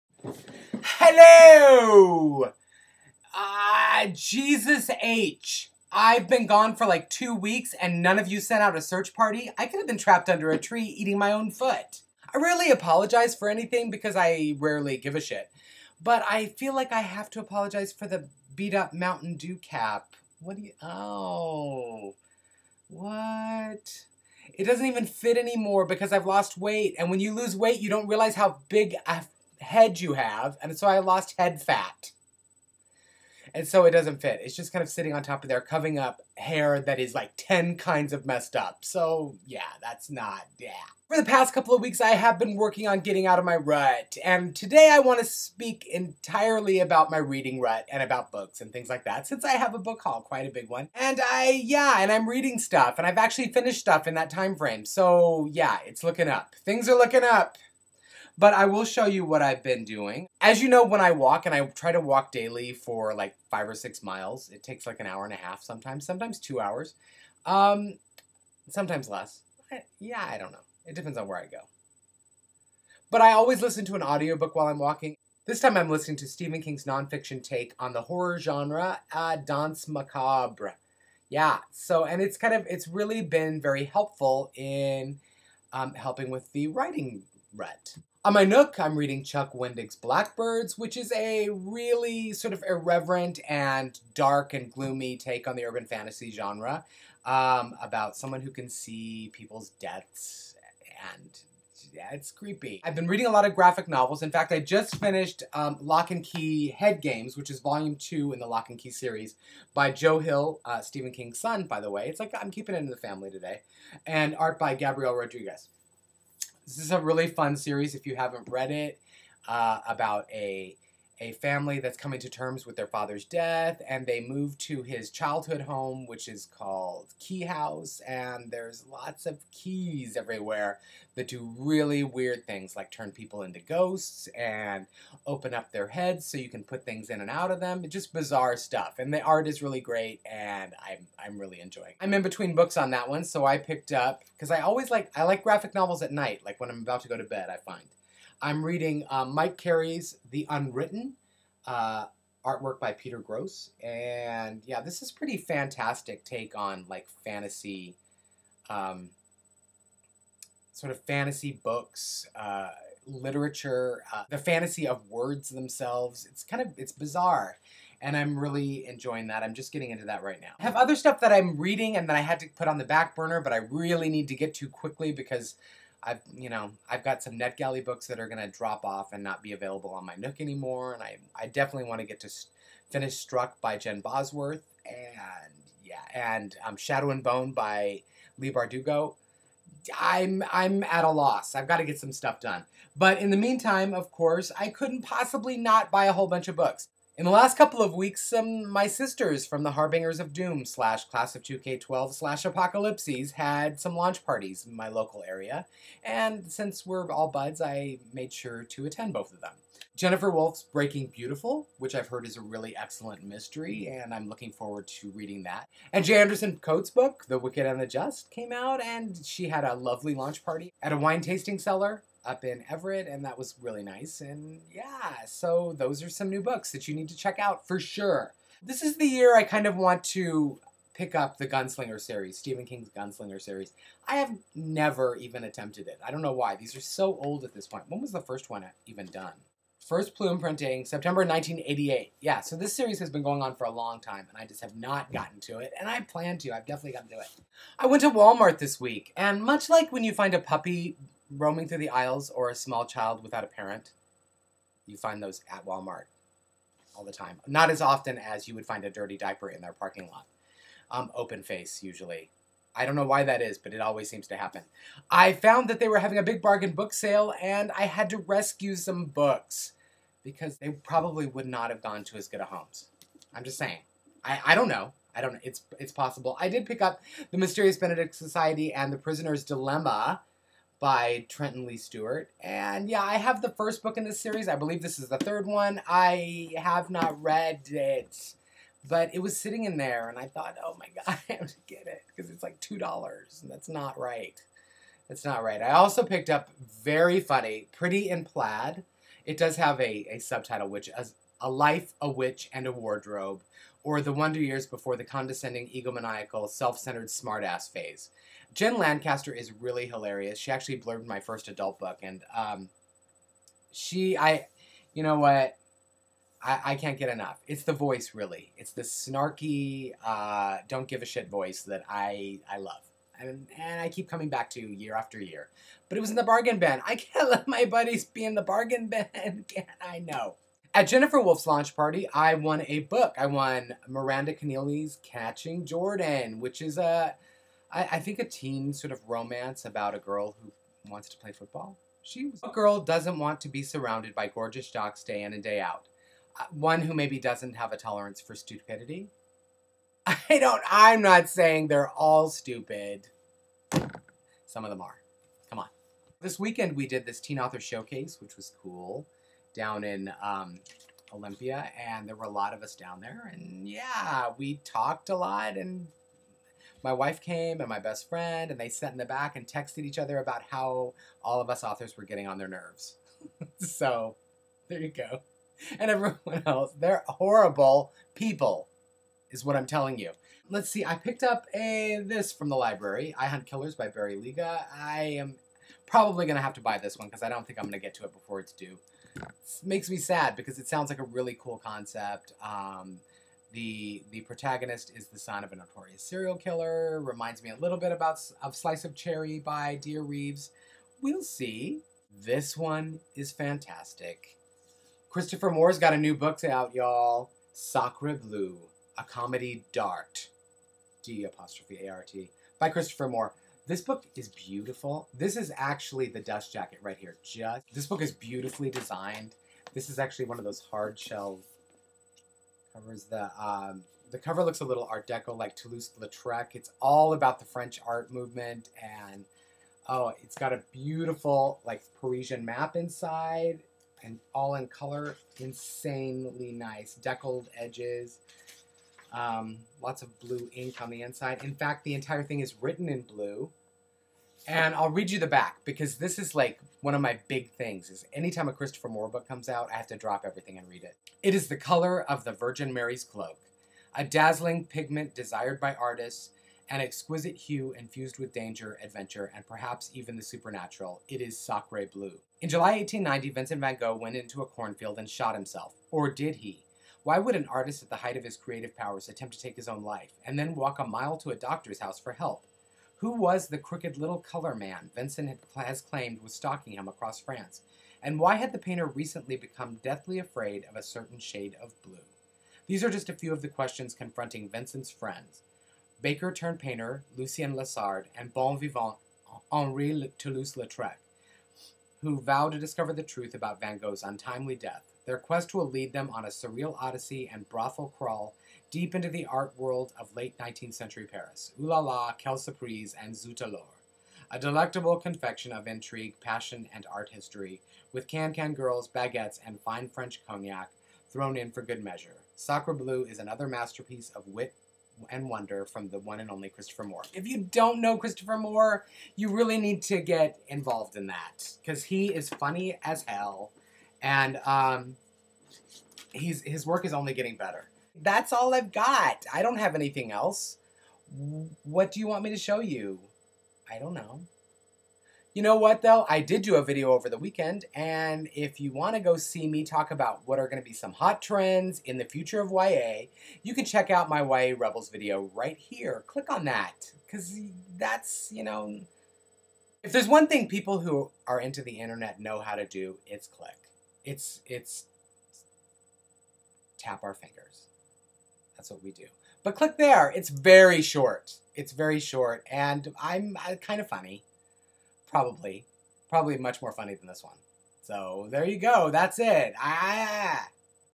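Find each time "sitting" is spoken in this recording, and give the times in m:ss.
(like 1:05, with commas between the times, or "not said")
0:34, 4:49.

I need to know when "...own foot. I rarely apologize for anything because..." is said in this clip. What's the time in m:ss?
0:11.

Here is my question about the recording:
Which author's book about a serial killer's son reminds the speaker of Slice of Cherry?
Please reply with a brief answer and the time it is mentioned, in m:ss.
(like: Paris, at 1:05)
Barry Lyga, at 6:23.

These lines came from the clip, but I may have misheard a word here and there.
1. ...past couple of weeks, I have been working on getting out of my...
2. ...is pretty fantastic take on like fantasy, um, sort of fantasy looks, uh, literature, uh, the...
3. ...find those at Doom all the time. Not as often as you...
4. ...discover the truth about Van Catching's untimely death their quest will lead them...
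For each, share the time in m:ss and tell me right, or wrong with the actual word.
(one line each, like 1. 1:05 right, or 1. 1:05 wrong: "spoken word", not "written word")
1. 0:41 right
2. 2:35 wrong: "books", not "looks"
3. 4:14 wrong: "Walmart", not "Doom"
4. 8:12 wrong: "Gogh", not "Catching".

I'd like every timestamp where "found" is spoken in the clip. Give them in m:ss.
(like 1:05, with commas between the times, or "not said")
4:25.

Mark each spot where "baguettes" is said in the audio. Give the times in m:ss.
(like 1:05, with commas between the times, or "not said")
8:28.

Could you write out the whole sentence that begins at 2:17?
It's just bizarre stuff, and the art is really great, and I'm, I'm really enjoying it.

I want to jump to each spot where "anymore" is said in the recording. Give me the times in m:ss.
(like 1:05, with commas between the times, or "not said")
0:25, 3:00.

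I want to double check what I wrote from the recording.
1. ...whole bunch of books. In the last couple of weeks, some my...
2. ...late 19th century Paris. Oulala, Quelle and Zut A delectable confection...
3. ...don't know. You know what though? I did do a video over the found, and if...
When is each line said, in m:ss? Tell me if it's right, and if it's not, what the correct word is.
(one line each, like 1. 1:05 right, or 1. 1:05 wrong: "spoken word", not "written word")
1. 3:16 right
2. 8:20 right
3. 8:53 wrong: "weekend", not "found".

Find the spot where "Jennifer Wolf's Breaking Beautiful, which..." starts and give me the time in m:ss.
3:29.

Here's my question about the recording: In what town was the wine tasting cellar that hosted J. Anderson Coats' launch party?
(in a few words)
Everett.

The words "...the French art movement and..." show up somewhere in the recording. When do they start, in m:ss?
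7:07.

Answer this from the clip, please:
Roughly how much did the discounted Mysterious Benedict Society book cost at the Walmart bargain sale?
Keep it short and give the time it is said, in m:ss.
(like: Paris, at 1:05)
$2, at 4:52.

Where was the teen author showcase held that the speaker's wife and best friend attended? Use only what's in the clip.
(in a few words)
Olympia.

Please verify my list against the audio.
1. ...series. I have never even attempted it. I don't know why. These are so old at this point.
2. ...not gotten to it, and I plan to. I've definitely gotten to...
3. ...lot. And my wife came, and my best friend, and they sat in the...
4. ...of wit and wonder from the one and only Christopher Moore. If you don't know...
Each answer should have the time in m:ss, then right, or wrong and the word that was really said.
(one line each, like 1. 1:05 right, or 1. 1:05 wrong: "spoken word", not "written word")
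1. 3:53 right
2. 4:04 right
3. 6:05 right
4. 8:34 right.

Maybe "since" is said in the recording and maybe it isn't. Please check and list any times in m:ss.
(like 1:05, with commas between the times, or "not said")
0:49, 3:26.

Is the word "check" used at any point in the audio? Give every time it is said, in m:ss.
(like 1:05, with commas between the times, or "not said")
3:47, 9:03.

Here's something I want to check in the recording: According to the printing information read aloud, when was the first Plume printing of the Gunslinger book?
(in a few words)
September 1988.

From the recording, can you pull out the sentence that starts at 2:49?
I'm just getting into that right now.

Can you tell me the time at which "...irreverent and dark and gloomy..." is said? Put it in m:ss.
1:32.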